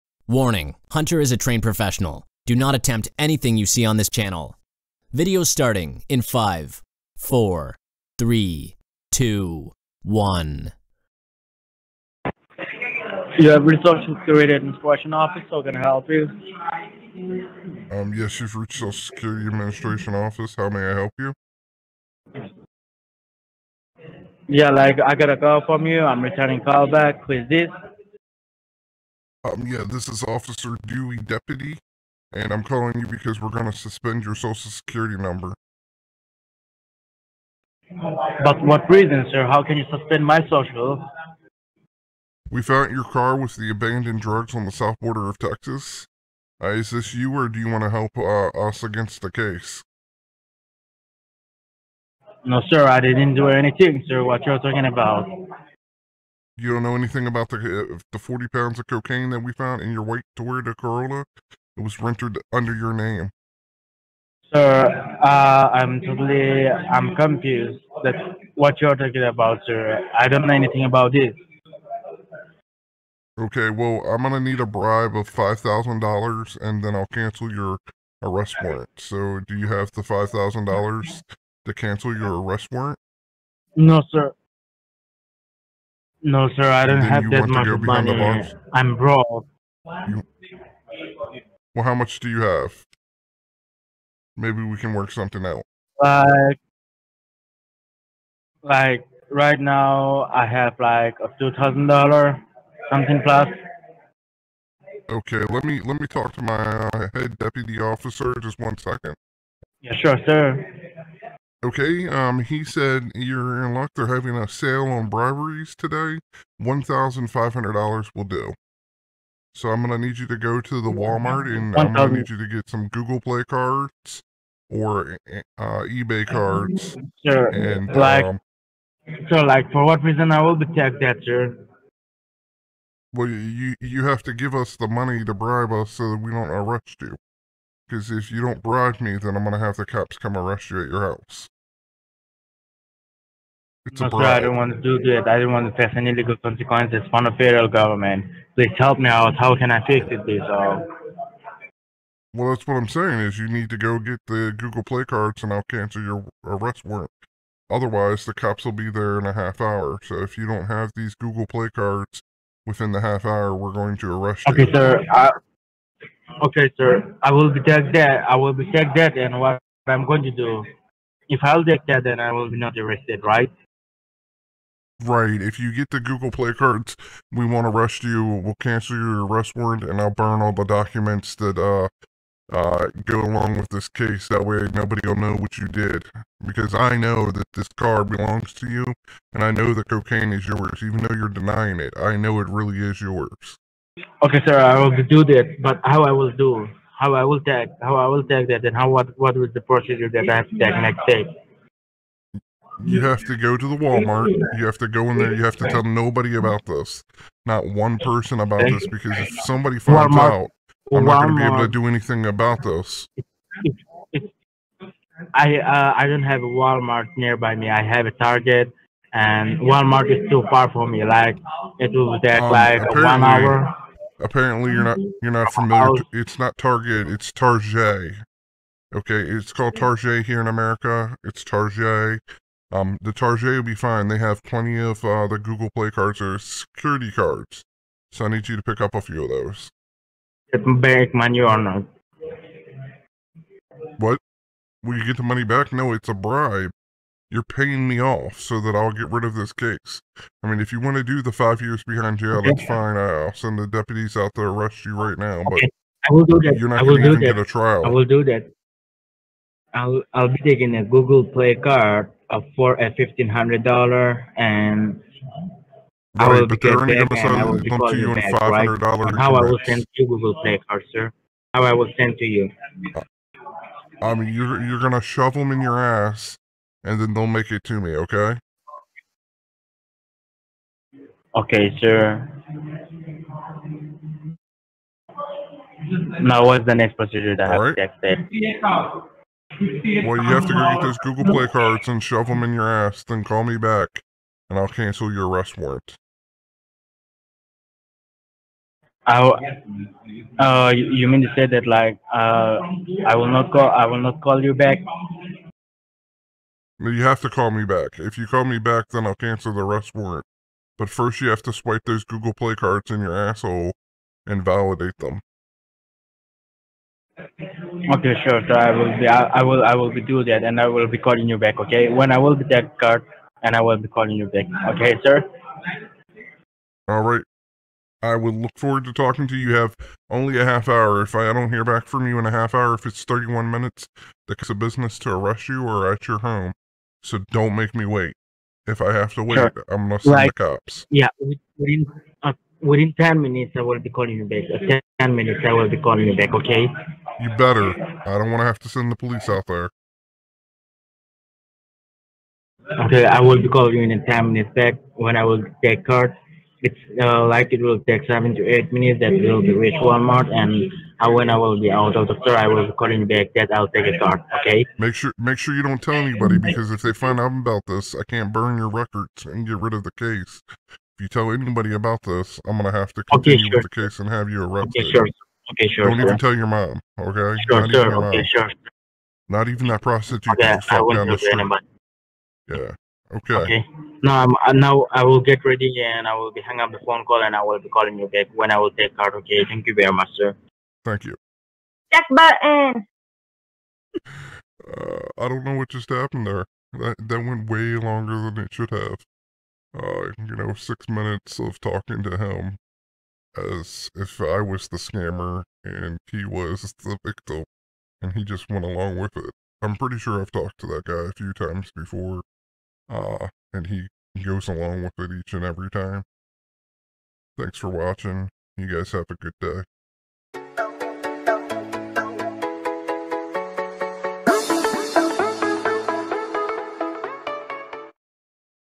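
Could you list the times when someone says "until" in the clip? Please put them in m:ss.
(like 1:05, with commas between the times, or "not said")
not said.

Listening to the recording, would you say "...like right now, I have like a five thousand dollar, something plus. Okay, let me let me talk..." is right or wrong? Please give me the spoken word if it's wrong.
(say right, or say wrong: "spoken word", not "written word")
wrong: "two", not "five".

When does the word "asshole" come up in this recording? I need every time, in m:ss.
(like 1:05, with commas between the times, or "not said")
5:13.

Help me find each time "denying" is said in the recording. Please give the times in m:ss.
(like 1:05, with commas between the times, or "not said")
3:11.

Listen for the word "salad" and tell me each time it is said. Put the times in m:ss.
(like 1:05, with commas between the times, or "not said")
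not said.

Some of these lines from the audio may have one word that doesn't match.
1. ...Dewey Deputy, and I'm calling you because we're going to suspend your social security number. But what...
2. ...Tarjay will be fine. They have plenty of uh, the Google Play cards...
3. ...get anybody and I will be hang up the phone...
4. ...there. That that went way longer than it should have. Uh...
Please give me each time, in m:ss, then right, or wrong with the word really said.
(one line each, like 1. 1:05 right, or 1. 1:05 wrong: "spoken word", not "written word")
1. 0:30 right
2. 3:53 right
3. 6:25 wrong: "ready", not "anybody"
4. 6:36 right.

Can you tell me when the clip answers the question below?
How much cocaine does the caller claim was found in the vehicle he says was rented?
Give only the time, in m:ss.
0:58.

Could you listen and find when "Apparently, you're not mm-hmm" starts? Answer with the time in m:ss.
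3:44.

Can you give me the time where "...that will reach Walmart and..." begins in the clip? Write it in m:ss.
5:58.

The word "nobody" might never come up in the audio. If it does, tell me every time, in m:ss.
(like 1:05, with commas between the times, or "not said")
3:04, 3:25.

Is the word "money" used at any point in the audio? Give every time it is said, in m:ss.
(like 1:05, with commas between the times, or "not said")
1:27, 2:14, 4:01, 4:05.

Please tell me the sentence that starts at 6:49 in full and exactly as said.
I'm pretty sure I've talked to that guy a few times before.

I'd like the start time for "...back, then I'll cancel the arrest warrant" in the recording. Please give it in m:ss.
5:08.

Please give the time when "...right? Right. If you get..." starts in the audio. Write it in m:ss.
2:53.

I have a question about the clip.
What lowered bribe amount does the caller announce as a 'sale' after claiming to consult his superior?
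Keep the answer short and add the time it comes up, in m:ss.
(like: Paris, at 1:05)
$1,500, at 1:56.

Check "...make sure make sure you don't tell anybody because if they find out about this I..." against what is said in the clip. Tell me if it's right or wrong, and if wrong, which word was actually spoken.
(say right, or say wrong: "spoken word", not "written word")
right.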